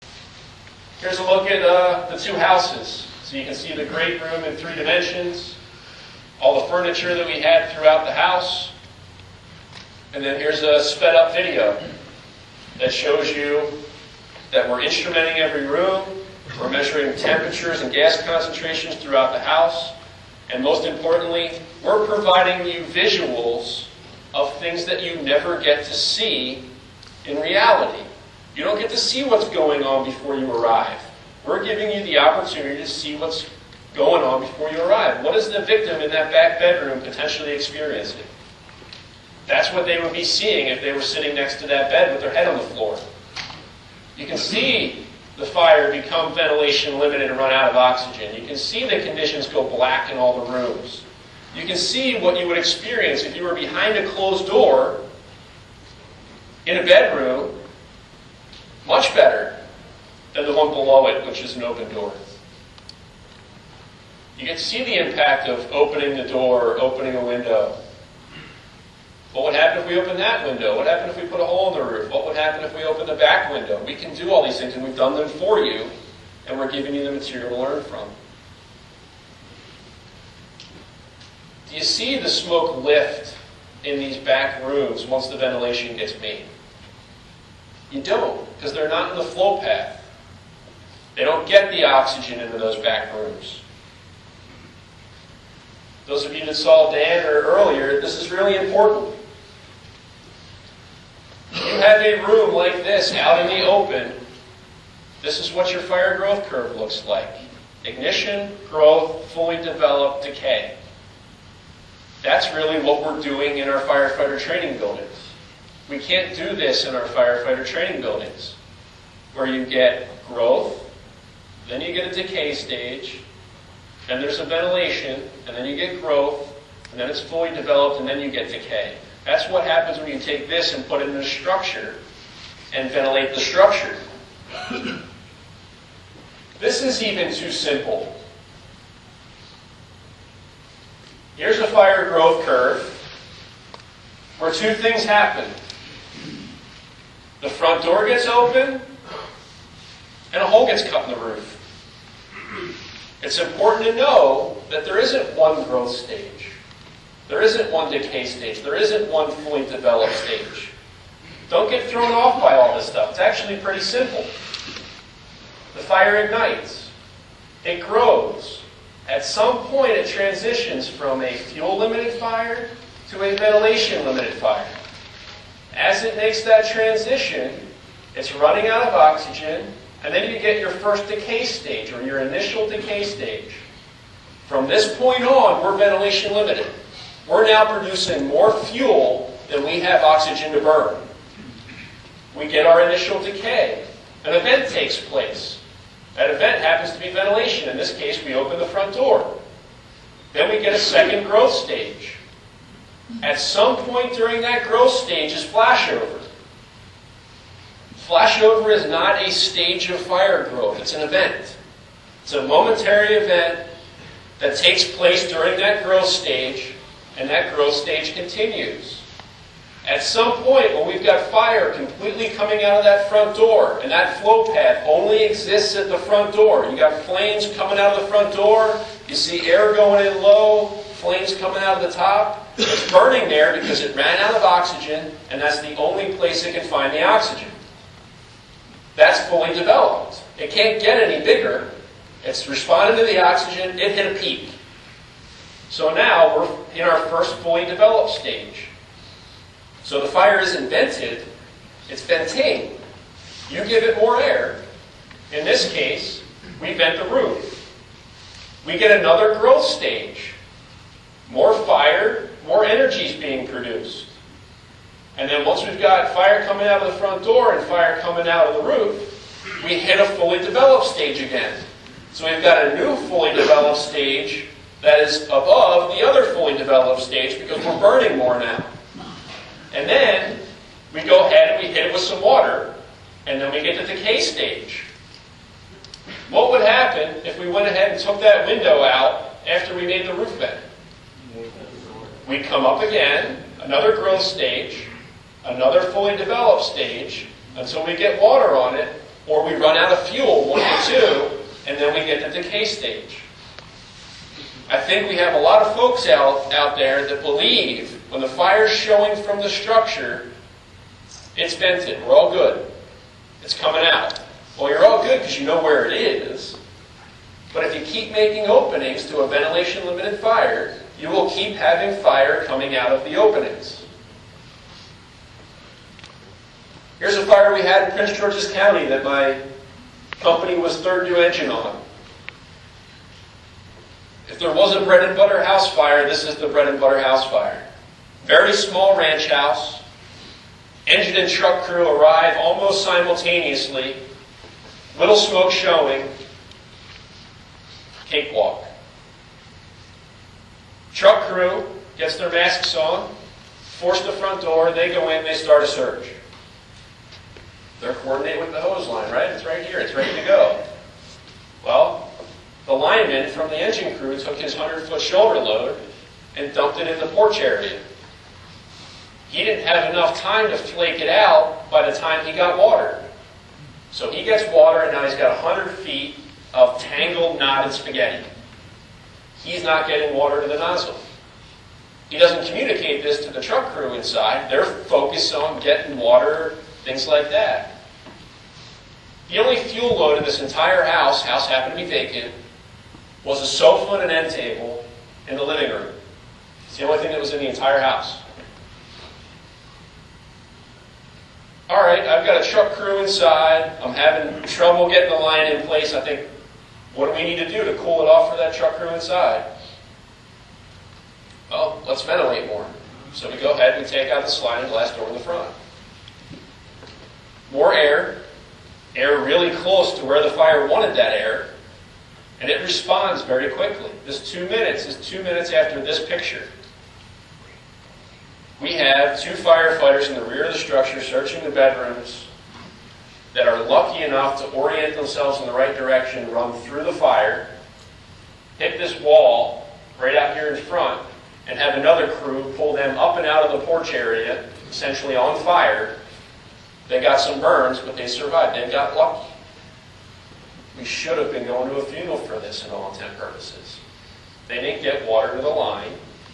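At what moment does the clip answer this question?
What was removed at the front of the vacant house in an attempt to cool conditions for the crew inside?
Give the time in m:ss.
6:54.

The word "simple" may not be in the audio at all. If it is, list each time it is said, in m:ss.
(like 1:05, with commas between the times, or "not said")
2:17, 2:43.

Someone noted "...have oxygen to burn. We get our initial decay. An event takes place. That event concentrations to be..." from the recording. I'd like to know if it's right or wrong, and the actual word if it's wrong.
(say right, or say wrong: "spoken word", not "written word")
wrong: "happens", not "concentrations".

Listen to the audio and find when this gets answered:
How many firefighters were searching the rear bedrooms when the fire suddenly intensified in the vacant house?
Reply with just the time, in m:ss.
7:09.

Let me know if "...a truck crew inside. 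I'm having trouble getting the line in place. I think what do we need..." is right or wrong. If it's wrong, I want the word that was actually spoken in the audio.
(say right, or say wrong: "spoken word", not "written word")
right.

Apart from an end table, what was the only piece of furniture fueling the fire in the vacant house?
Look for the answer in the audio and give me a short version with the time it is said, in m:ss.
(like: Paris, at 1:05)
a sofa, at 6:33.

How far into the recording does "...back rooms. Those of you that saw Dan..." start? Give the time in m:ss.
1:32.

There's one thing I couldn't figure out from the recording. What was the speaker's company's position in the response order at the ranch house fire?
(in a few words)
third due engine.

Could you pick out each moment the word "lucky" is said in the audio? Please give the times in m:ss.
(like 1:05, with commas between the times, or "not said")
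7:13, 7:28.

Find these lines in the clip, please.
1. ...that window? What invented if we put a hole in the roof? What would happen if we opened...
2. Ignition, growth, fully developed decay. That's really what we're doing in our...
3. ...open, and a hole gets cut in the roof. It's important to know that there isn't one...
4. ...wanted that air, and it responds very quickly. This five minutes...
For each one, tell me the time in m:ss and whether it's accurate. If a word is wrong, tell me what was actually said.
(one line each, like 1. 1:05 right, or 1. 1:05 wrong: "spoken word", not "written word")
1. 1:10 wrong: "happened", not "invented"
2. 1:47 right
3. 2:28 right
4. 7:00 wrong: "two", not "five".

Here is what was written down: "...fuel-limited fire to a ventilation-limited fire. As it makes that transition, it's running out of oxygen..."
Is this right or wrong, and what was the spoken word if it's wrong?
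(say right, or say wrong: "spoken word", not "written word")
right.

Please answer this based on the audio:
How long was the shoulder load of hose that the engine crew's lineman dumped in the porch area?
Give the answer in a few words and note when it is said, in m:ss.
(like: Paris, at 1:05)
100 feet, at 6:04.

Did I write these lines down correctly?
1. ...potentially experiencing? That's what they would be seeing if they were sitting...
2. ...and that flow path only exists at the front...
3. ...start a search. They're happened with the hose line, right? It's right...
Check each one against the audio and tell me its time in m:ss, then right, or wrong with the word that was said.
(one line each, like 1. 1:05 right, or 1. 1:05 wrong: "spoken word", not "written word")
1. 0:37 right
2. 3:43 right
3. 5:55 wrong: "coordinated", not "happened".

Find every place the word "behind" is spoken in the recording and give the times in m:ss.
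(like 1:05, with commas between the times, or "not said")
0:53.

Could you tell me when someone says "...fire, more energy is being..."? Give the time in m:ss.
4:21.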